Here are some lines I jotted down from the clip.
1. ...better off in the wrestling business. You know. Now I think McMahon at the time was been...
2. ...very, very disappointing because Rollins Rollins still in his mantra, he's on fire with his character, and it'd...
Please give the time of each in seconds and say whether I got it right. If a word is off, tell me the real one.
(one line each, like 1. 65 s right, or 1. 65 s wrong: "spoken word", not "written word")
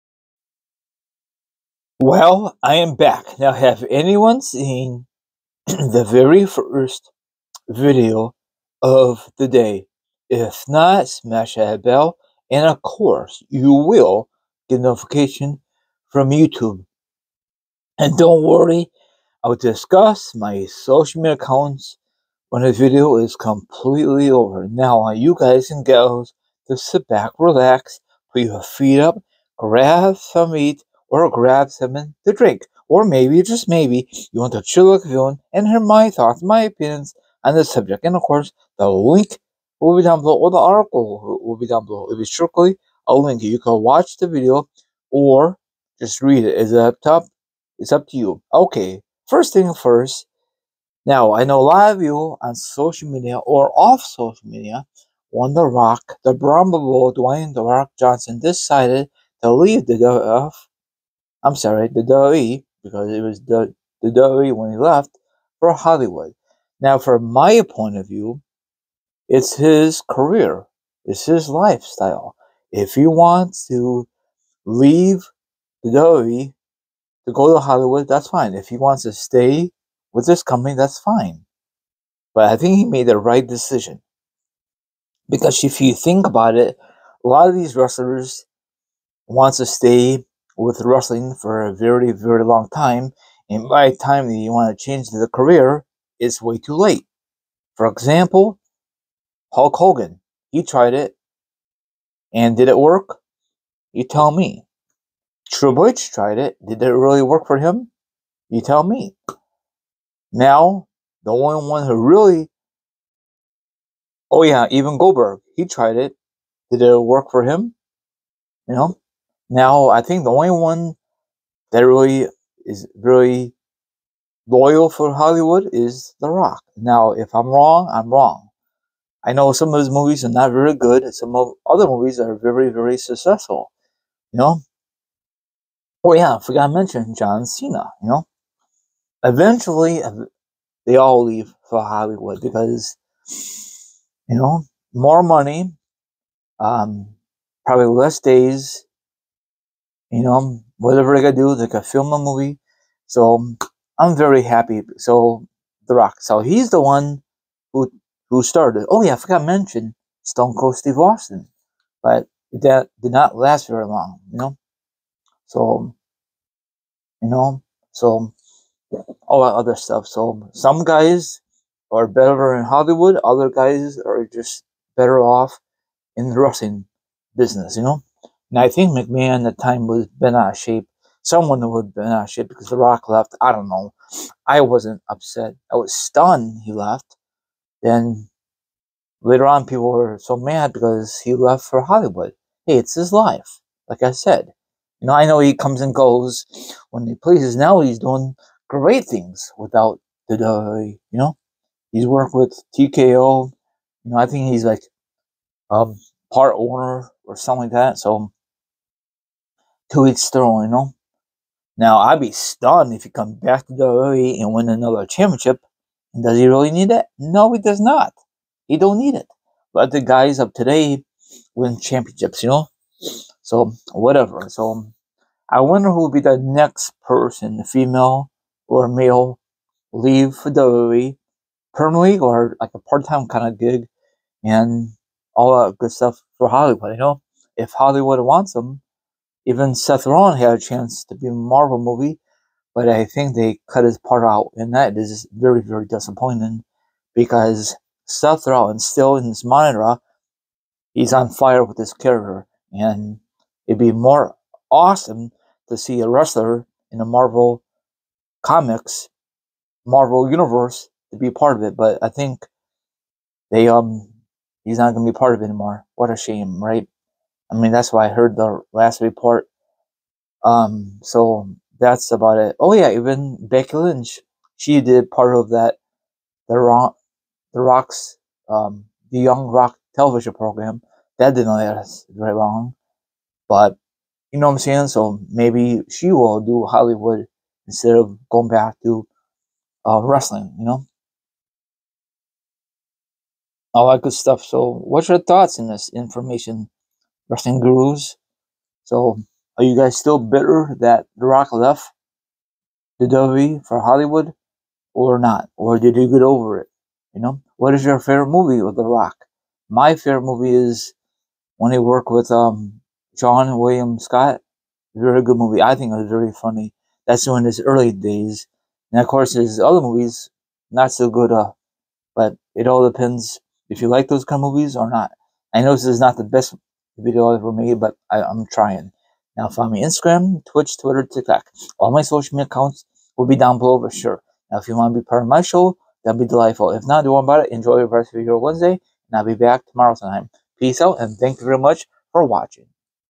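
1. 174 s right
2. 245 s wrong: "Seth", not "Rollins".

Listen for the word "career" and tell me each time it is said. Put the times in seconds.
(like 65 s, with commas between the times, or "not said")
70 s, 95 s.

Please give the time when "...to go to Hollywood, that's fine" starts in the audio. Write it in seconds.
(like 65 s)
77 s.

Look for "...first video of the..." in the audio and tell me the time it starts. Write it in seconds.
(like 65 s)
6 s.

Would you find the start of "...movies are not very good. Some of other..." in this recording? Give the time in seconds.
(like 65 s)
129 s.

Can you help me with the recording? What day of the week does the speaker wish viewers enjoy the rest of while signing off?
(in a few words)
Wednesday.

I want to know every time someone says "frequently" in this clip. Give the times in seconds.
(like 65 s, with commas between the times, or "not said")
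not said.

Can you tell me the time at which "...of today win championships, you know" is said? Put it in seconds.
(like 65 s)
220 s.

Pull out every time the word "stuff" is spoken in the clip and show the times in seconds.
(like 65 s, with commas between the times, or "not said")
169 s, 235 s, 294 s.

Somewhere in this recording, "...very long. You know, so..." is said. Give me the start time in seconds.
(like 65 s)
163 s.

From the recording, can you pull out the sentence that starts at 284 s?
So maybe she will do Hollywood instead of going back to uh, wrestling.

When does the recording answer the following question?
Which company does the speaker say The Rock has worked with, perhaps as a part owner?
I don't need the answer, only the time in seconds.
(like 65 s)
202 s.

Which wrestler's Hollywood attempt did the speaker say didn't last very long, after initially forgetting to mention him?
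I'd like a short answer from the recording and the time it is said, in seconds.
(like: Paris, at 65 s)
Stone Cold Steve Austin, at 160 s.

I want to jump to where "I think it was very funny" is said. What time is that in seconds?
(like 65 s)
315 s.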